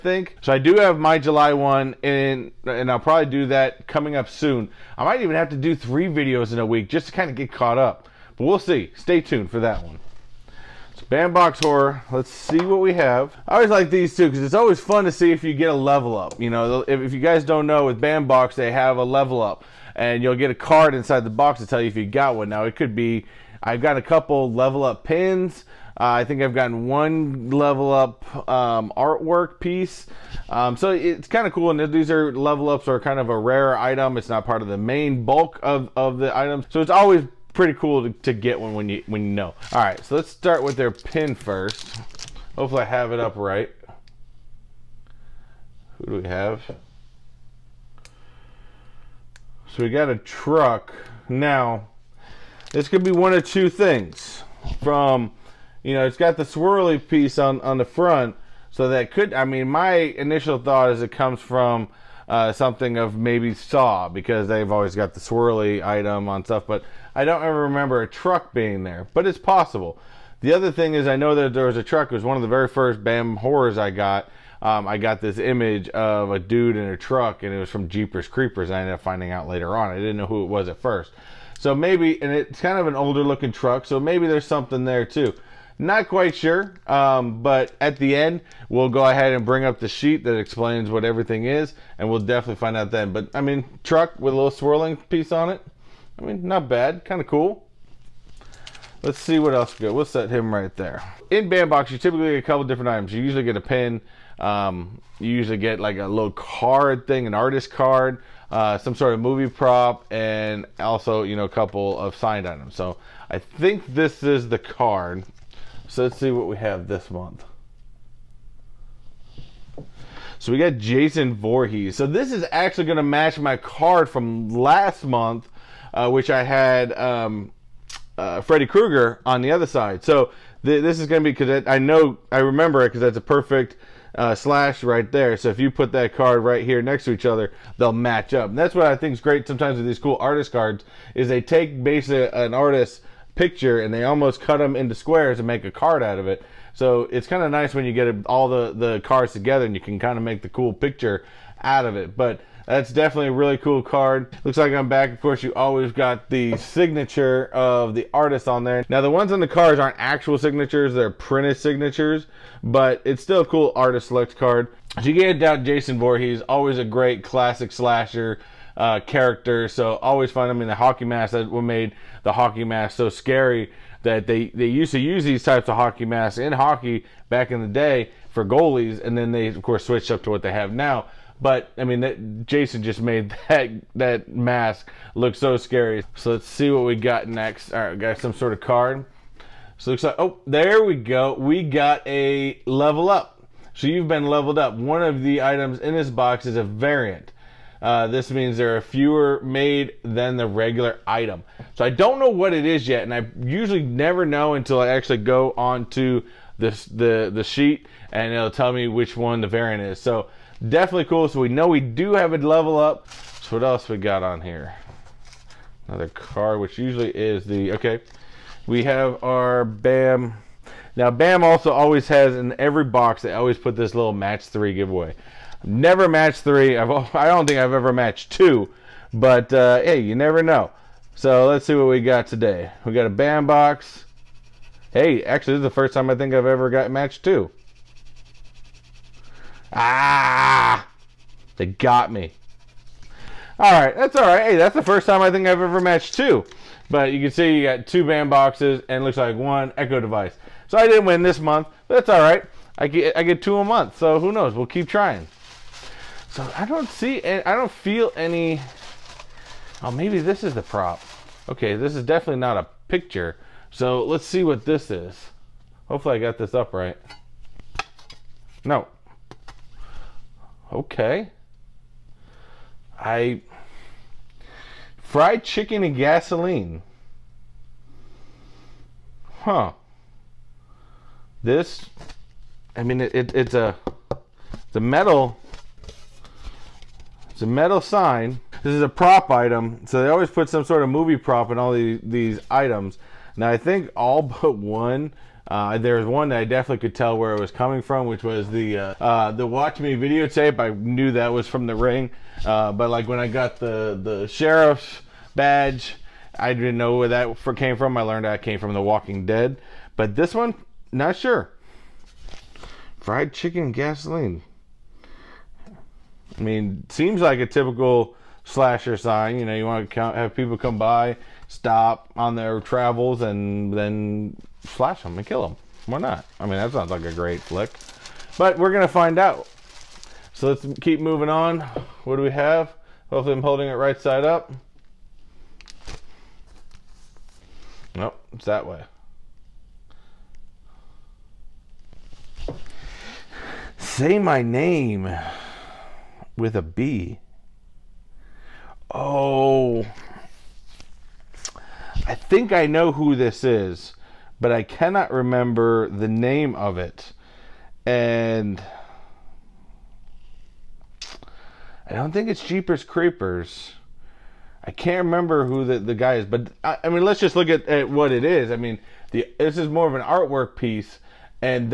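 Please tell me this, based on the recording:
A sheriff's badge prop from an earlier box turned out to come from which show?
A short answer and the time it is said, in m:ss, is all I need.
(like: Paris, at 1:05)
The Walking Dead, at 5:08.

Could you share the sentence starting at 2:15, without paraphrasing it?
So if you put that card right here next to each other, they'll match up.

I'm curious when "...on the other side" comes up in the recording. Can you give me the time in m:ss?
2:09.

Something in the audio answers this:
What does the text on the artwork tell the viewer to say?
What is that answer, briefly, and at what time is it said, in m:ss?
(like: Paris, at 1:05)
Say my name with a B, at 5:43.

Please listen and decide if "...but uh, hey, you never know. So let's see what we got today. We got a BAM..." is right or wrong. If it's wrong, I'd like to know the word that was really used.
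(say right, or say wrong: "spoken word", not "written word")
right.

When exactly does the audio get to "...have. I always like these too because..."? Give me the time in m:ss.
0:12.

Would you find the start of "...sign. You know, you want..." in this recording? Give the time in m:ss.
5:18.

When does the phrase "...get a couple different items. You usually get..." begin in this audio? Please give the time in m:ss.
1:42.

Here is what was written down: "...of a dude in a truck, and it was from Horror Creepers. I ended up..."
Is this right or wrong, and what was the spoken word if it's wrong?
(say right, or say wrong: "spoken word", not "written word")
wrong: "Jeepers", not "Horror".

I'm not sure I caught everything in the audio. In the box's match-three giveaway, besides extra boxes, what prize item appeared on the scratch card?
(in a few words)
Echo device.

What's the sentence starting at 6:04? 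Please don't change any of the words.
I can't remember who the, the guy is, but I, I mean, let's just look at, at what it is.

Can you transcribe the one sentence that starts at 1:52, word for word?
So I think this is the card.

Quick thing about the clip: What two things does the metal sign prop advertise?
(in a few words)
Fried chicken and gasoline.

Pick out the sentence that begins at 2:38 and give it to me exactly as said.
Now, the ones on the cards aren't actual signatures.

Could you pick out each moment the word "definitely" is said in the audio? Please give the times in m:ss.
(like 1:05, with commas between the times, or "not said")
1:32, 2:32, 3:30, 4:22, 4:56.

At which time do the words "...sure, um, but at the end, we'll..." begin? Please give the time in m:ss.
1:26.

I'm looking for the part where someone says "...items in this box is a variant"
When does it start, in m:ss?
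3:15.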